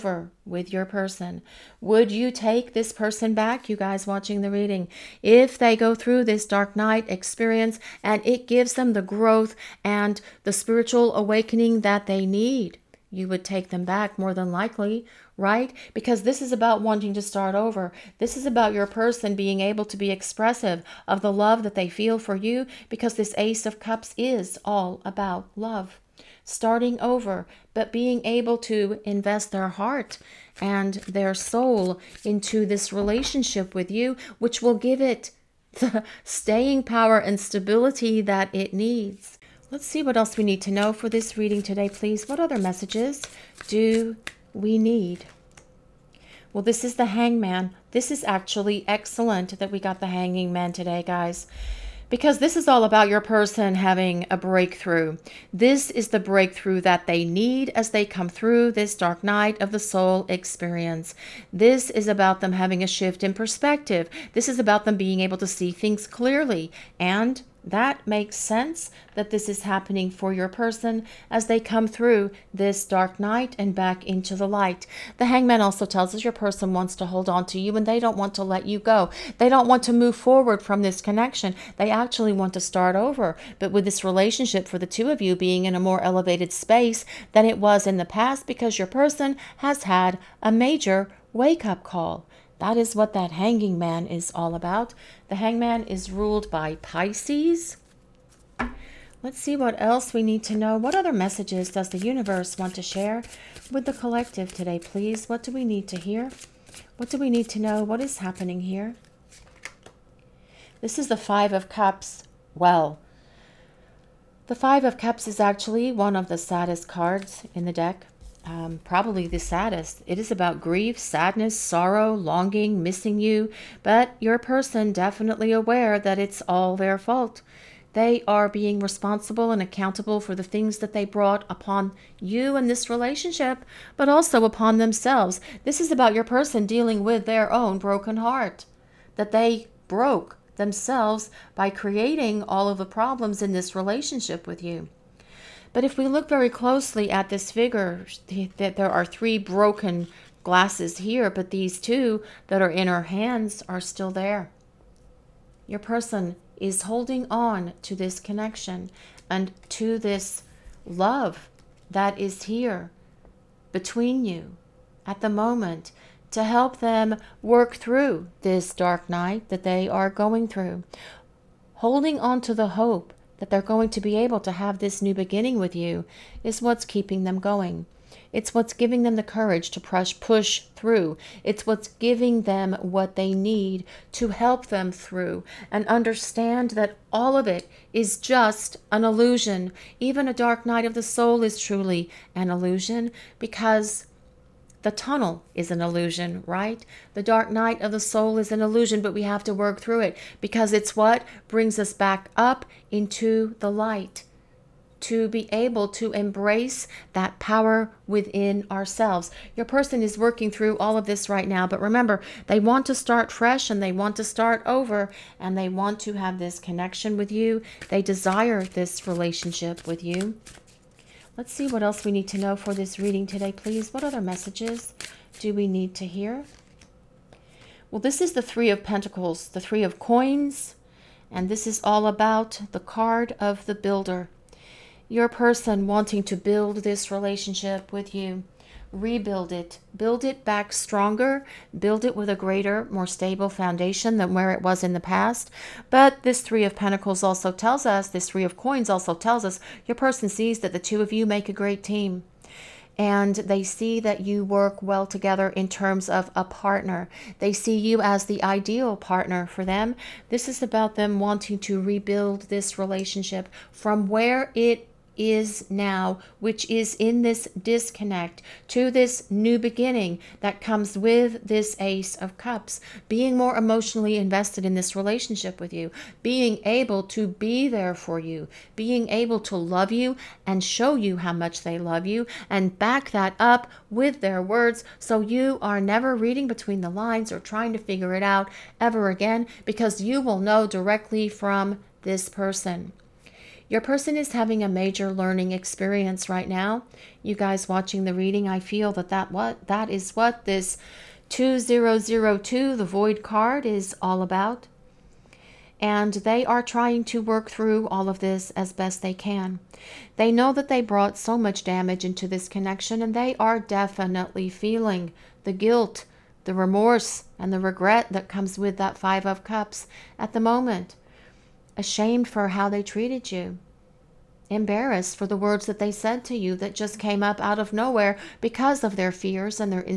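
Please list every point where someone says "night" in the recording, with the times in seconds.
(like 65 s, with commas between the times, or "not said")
6 s, 59 s, 73 s, 169 s, 190 s, 197 s.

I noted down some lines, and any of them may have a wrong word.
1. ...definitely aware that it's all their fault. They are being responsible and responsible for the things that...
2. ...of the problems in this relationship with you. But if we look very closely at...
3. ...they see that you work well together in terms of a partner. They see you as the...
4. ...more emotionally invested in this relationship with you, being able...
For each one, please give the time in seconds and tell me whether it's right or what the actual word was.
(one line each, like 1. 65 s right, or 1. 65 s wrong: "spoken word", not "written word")
1. 124 s wrong: "accountable", not "responsible"
2. 142 s right
3. 253 s right
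4. 273 s right.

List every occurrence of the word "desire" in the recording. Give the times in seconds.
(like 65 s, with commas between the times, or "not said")
218 s.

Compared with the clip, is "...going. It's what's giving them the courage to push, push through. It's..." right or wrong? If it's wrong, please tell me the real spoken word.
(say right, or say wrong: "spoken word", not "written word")
right.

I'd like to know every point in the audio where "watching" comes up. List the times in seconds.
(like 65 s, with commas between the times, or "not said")
4 s, 297 s.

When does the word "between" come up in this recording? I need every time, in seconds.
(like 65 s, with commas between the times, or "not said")
163 s, 286 s.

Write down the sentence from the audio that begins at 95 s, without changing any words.
The hangman is ruled by Pisces.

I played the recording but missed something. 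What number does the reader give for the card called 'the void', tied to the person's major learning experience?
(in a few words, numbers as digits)
2002.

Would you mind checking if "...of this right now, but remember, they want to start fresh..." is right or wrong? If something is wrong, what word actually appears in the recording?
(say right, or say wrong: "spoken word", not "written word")
right.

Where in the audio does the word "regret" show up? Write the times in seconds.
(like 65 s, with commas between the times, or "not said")
317 s.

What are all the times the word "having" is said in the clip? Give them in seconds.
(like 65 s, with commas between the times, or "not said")
53 s, 62 s, 294 s.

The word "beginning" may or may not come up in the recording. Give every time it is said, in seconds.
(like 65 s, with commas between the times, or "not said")
175 s, 269 s.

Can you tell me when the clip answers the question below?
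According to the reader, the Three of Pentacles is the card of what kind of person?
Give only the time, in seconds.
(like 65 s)
233 s.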